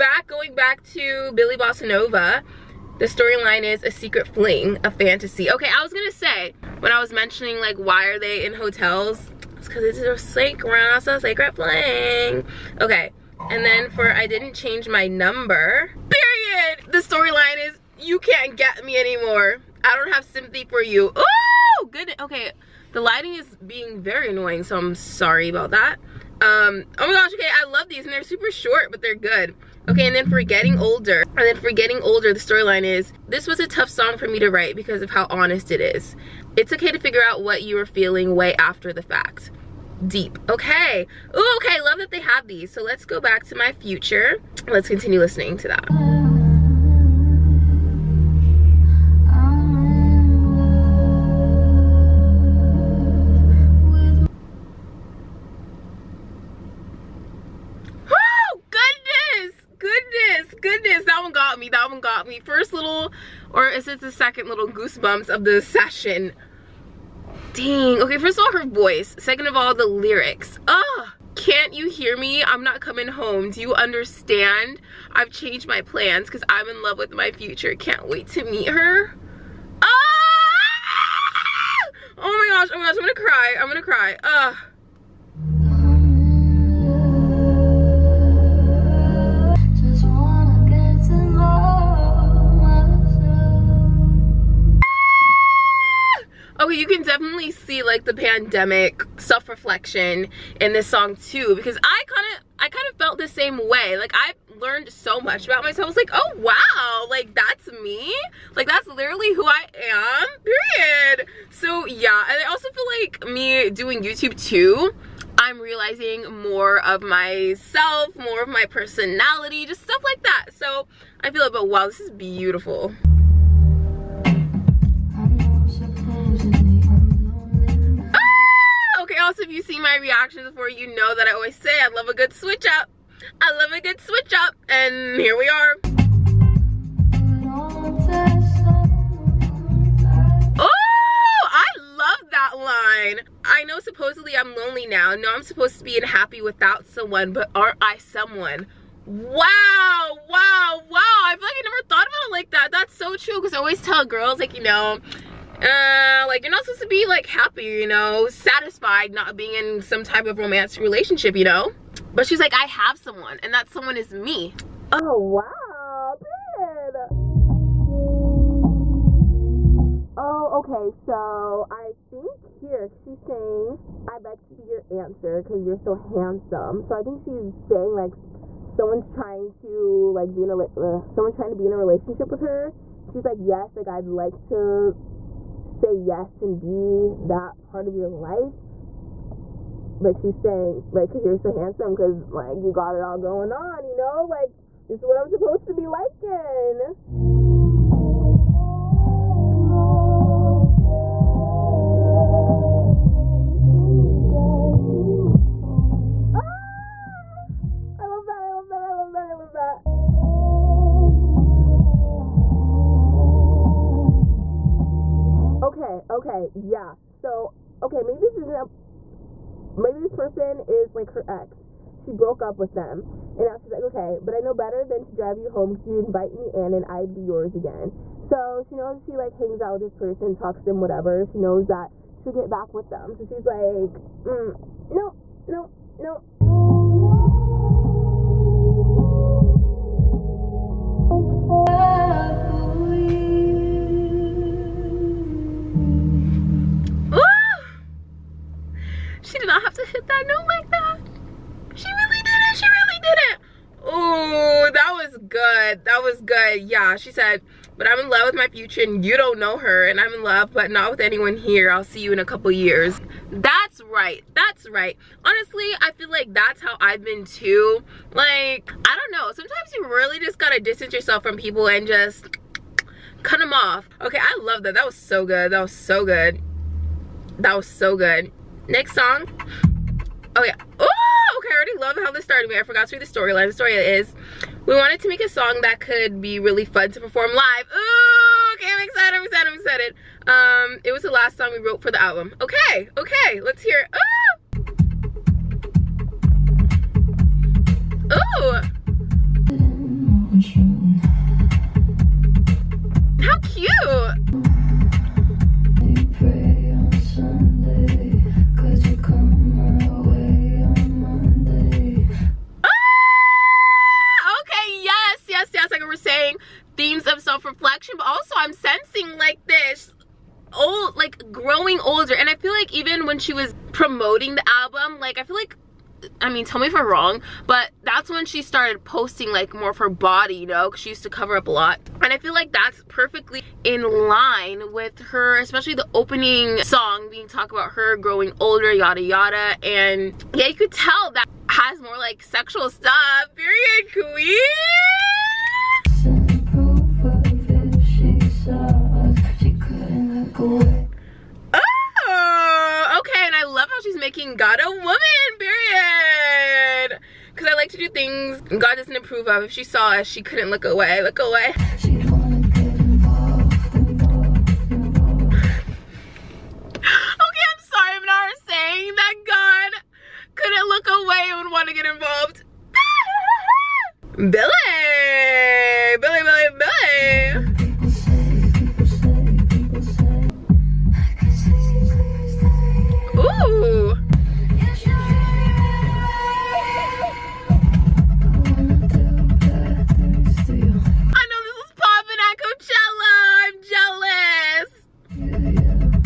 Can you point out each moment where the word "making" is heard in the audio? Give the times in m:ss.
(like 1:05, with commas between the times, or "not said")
5:53.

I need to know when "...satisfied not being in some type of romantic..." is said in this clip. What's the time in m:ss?
2:38.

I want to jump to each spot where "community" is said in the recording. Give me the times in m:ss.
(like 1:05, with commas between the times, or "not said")
not said.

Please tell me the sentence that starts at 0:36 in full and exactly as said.
It's okay to figure out what you were feeling way after the fact deep.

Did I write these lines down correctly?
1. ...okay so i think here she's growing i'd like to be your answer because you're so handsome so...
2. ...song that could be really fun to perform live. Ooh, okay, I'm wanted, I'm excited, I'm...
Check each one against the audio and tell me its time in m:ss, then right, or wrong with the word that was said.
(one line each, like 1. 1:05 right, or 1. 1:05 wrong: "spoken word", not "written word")
1. 2:50 wrong: "saying", not "growing"
2. 4:45 wrong: "excited", not "wanted".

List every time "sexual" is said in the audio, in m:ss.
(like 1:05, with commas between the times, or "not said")
5:42.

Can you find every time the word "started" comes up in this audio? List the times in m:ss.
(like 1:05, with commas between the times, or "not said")
4:42, 5:28.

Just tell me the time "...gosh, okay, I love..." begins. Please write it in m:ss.
0:27.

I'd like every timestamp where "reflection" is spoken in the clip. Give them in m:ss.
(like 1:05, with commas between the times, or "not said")
1:39, 5:17.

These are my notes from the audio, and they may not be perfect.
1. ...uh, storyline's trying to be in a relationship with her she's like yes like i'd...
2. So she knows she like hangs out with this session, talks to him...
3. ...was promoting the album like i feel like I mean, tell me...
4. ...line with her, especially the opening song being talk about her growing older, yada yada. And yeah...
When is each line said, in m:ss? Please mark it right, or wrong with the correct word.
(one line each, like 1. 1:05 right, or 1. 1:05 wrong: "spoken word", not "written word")
1. 3:00 wrong: "someone", not "storyline"
2. 3:48 wrong: "person", not "session"
3. 5:23 right
4. 5:34 right.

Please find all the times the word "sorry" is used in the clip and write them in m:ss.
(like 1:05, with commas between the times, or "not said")
0:24, 6:07.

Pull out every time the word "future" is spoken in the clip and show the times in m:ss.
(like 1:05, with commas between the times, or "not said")
0:43, 1:17, 4:18.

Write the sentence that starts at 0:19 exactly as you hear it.
I don't have sympathy for you.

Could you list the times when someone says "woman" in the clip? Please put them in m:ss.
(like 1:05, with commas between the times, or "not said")
5:54.